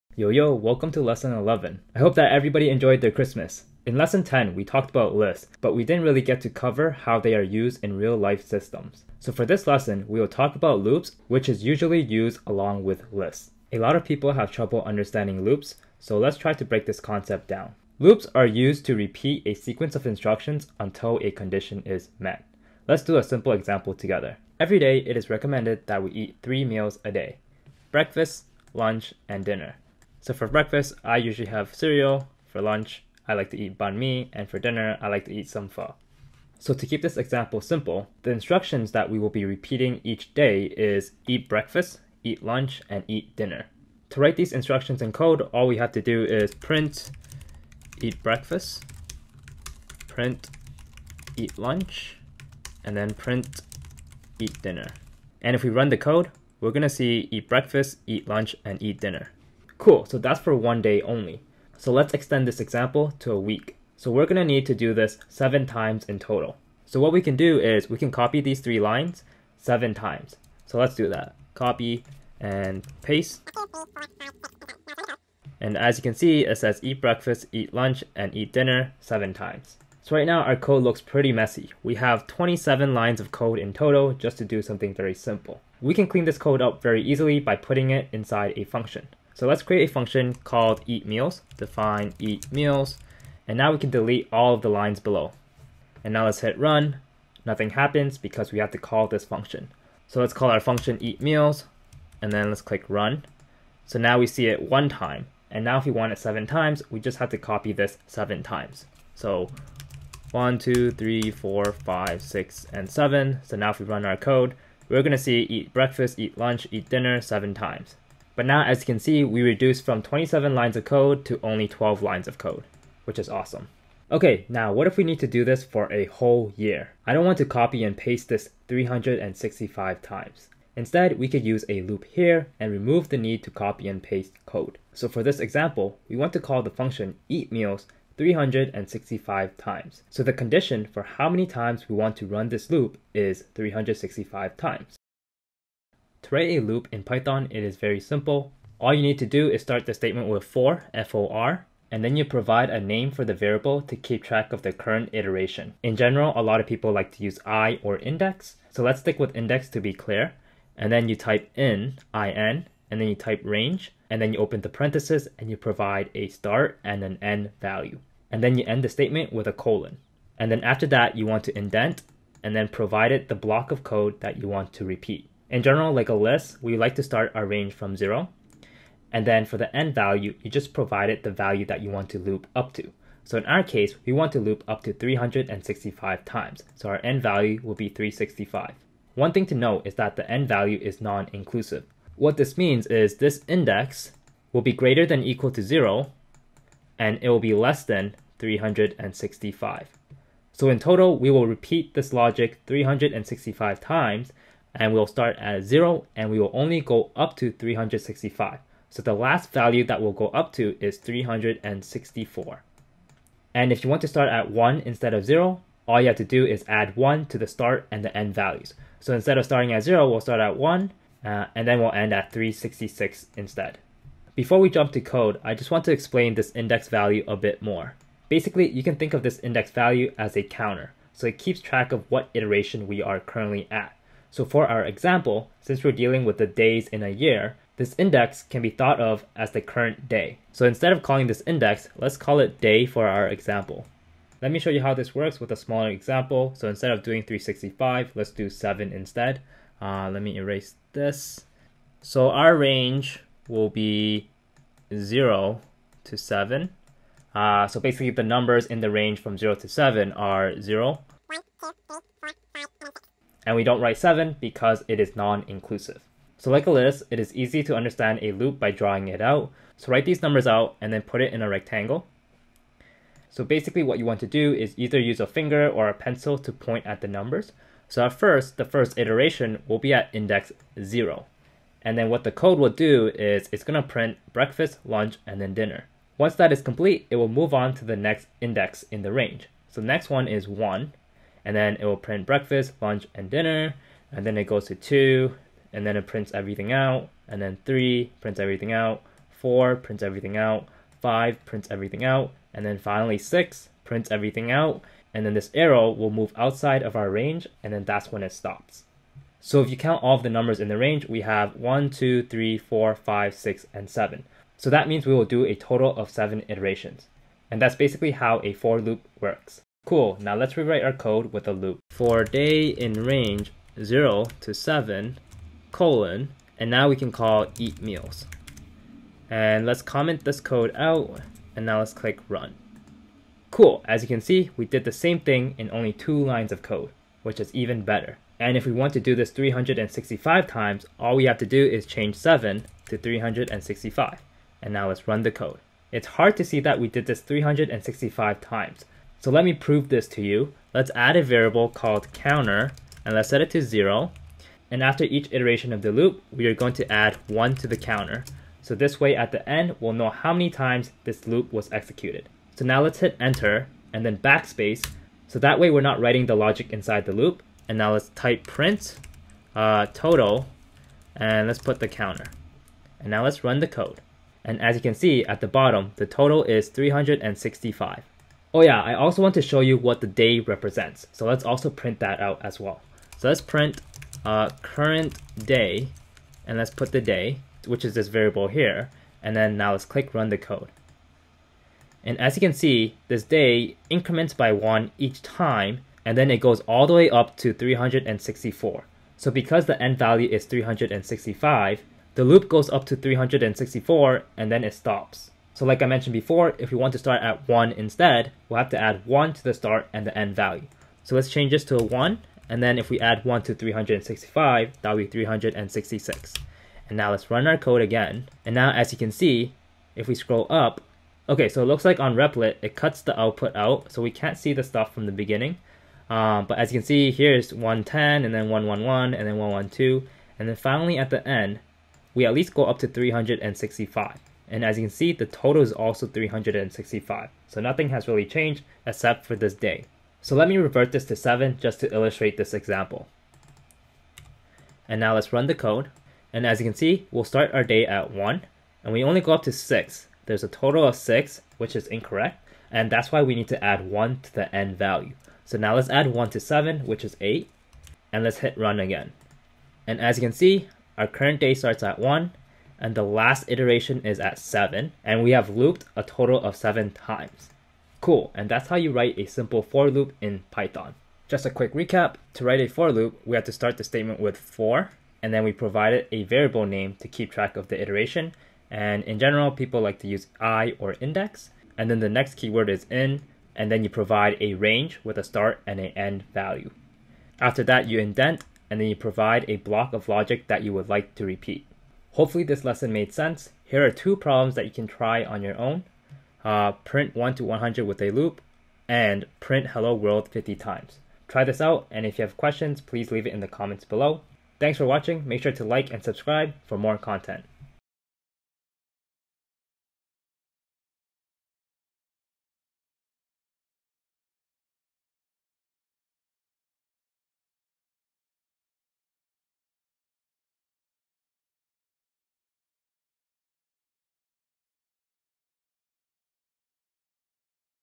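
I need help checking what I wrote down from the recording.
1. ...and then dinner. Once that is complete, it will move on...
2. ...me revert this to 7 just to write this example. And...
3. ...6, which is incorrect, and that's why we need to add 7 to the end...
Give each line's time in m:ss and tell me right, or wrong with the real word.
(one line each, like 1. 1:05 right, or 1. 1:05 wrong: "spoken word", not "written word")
1. 4:45 right
2. 7:20 wrong: "illustrate", not "write"
3. 7:30 wrong: "1", not "7".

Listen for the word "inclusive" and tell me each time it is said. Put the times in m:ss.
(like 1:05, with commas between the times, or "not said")
3:11, 4:25.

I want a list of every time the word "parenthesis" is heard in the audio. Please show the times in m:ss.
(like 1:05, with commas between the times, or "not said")
2:44.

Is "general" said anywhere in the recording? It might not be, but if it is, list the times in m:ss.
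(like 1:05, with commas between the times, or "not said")
2:35, 2:55, 7:59.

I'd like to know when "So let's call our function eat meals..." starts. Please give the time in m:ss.
1:40.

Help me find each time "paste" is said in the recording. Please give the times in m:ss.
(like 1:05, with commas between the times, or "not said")
1:13, 2:07, 2:14.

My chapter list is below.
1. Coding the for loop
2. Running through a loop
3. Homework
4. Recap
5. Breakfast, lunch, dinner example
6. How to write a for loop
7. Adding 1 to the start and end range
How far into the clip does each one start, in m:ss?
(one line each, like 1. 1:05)
1. 5:20
2. 4:41
3. 8:12
4. 7:52
5. 0:18
6. 2:32
7. 6:45.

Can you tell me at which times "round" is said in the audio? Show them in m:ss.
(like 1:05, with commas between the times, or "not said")
not said.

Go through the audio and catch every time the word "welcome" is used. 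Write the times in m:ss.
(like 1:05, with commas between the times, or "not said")
0:00.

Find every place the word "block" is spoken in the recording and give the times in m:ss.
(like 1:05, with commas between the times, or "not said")
2:53, 8:09.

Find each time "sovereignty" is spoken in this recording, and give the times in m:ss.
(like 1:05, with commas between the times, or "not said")
not said.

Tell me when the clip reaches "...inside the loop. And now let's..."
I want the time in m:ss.
6:06.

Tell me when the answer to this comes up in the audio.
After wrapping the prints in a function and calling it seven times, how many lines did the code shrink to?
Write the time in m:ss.
2:01.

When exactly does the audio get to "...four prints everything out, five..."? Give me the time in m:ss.
4:59.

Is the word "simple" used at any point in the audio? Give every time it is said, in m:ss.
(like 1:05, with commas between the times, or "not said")
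0:23, 0:37, 1:25, 2:27, 7:49.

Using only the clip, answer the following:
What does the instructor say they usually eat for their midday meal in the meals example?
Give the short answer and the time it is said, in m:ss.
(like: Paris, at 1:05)
banh mi, at 0:33.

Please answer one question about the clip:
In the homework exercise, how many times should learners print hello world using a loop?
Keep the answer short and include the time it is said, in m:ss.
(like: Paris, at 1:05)
50, at 8:20.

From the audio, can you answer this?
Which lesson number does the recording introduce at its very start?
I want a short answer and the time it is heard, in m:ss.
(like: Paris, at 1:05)
11, at 0:01.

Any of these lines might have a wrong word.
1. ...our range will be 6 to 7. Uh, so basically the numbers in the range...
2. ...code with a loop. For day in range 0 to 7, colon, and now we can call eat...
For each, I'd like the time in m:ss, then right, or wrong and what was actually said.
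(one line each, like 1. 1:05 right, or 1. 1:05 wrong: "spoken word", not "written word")
1. 4:12 wrong: "0", not "6"
2. 5:20 right.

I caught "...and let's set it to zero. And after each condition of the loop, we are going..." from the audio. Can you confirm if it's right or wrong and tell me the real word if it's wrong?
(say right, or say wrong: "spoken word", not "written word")
wrong: "iteration", not "condition".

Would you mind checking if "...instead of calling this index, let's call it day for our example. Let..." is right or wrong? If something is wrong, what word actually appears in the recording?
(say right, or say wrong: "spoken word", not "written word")
right.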